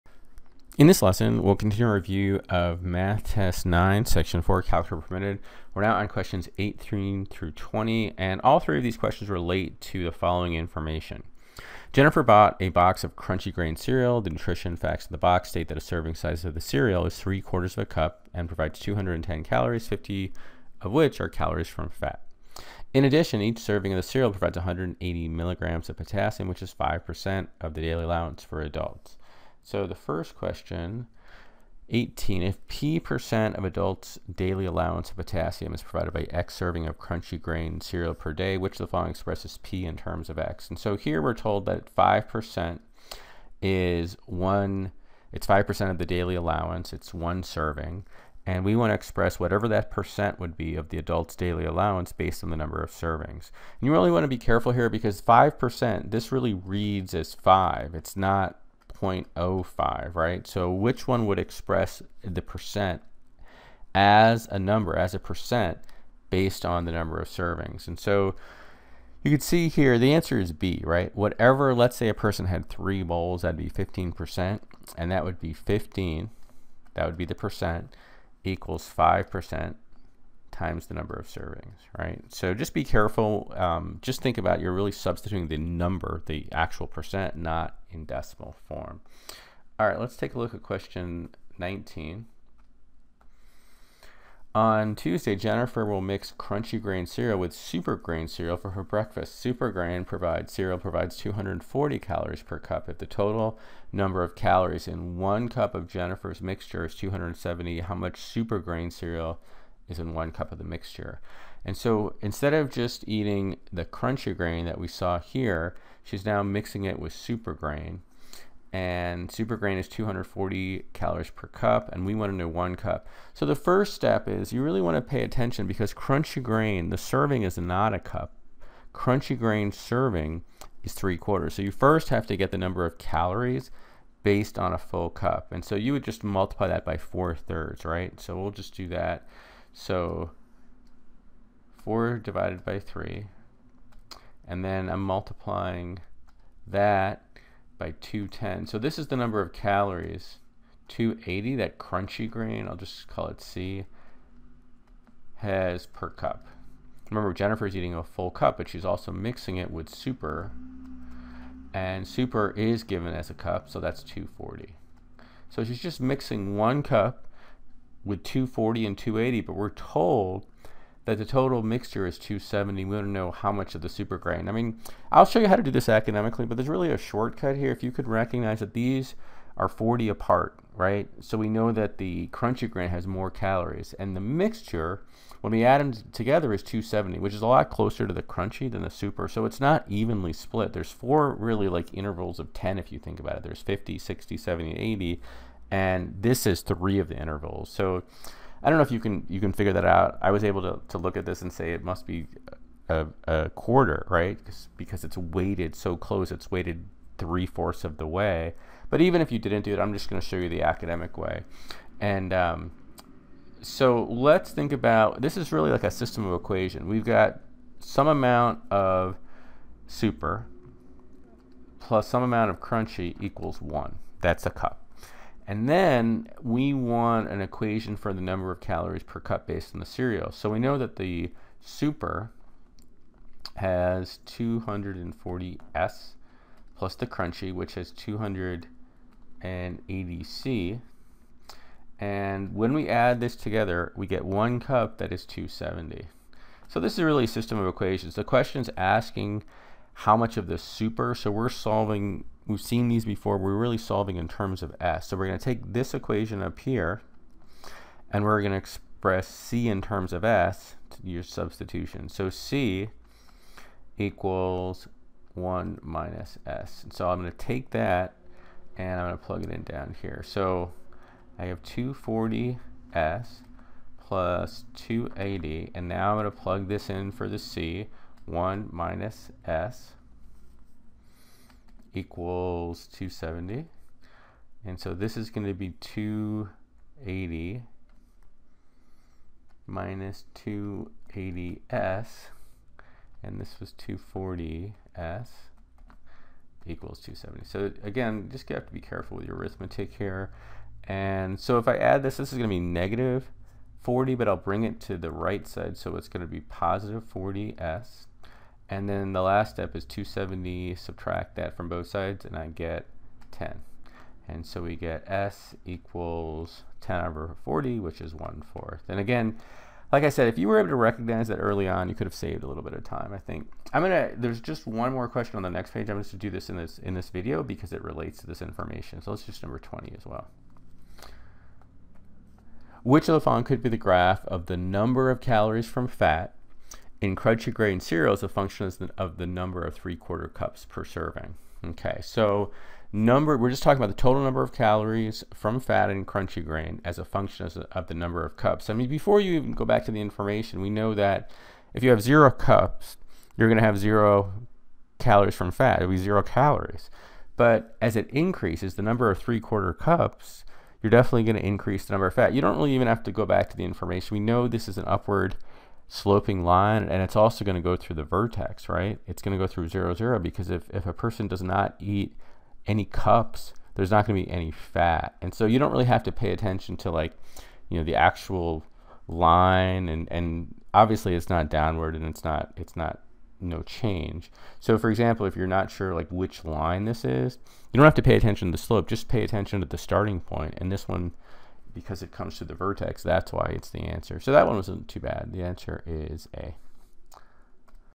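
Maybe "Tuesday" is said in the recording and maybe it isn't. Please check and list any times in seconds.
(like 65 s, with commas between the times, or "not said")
94 s.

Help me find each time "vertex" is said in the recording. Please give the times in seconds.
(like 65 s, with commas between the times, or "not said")
368 s, 392 s.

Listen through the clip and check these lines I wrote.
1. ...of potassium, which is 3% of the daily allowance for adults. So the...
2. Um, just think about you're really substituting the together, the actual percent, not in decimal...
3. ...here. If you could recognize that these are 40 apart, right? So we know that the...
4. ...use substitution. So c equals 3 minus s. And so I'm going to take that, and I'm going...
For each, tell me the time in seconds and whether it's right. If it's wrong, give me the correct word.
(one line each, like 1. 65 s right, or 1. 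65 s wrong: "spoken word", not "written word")
1. 25 s wrong: "5", not "3"
2. 83 s wrong: "number", not "together"
3. 177 s right
4. 261 s wrong: "1", not "3".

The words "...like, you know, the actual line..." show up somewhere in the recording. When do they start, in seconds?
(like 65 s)
376 s.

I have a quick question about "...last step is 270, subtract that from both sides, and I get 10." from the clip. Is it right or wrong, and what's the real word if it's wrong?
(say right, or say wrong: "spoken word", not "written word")
right.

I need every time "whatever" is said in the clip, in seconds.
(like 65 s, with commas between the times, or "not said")
49 s, 71 s.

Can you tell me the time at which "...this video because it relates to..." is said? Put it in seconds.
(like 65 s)
326 s.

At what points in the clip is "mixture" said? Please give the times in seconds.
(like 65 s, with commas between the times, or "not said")
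106 s, 110 s, 171 s, 184 s.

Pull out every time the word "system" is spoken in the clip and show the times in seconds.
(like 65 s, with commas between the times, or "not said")
215 s, 247 s.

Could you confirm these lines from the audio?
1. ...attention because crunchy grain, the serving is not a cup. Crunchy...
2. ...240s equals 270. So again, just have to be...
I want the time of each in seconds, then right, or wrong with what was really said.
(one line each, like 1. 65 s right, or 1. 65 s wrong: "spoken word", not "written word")
1. 125 s right
2. 293 s right.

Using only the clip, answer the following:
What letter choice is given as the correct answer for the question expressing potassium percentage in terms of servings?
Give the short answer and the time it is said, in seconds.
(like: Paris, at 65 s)
B, at 69 s.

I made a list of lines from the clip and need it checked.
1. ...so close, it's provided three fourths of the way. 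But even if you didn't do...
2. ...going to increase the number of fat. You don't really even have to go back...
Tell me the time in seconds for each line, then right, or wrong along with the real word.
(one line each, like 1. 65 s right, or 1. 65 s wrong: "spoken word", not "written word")
1. 205 s wrong: "weighted", not "provided"
2. 361 s right.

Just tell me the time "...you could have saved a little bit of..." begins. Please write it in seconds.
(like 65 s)
321 s.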